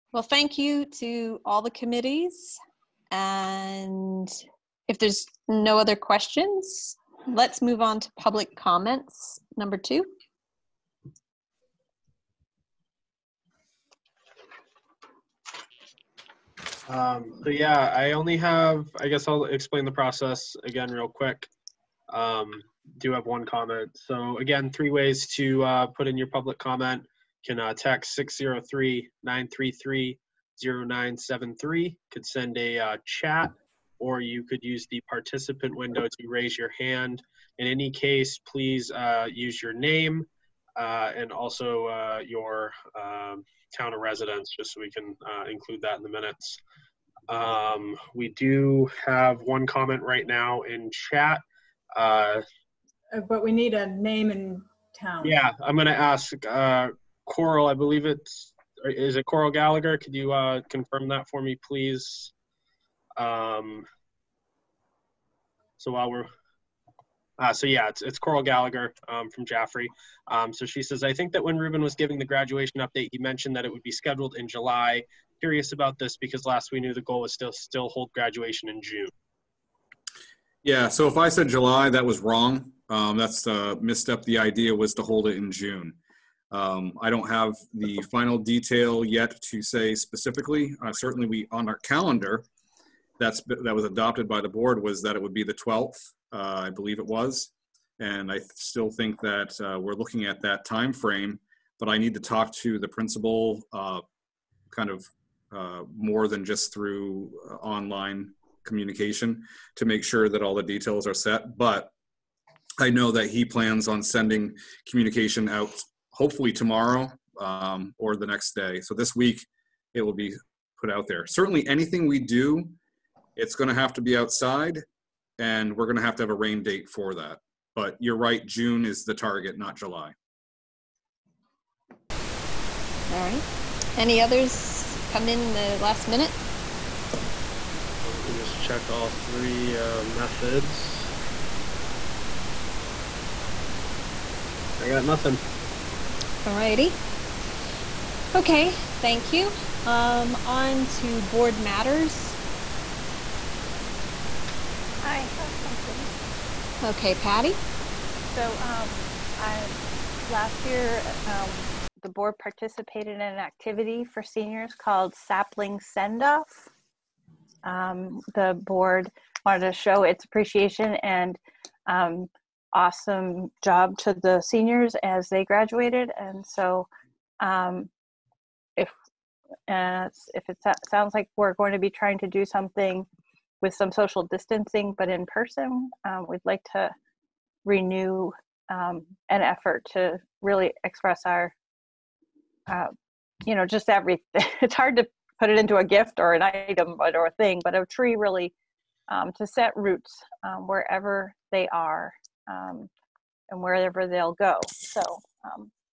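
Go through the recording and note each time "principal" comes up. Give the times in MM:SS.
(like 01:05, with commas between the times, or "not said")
01:42.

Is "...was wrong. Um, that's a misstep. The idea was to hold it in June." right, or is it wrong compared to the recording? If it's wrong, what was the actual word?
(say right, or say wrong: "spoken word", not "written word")
right.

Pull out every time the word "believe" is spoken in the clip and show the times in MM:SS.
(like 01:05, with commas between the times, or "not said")
00:57, 01:36.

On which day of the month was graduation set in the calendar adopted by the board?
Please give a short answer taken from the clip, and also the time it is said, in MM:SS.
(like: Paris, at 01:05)
12th, at 01:35.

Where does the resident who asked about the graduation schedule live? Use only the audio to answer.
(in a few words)
Jaffrey.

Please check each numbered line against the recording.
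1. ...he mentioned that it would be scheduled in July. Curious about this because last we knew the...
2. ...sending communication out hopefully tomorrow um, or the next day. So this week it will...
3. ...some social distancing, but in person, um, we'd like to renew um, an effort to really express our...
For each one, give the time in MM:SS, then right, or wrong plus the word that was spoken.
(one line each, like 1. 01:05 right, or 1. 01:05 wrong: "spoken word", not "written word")
1. 01:13 right
2. 01:54 right
3. 03:03 right.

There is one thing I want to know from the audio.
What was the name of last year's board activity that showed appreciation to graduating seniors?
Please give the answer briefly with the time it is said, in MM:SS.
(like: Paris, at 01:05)
Sapling Send Off, at 02:45.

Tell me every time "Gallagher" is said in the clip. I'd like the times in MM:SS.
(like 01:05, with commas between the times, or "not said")
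00:59, 01:08.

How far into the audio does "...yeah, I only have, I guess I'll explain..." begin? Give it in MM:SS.
00:17.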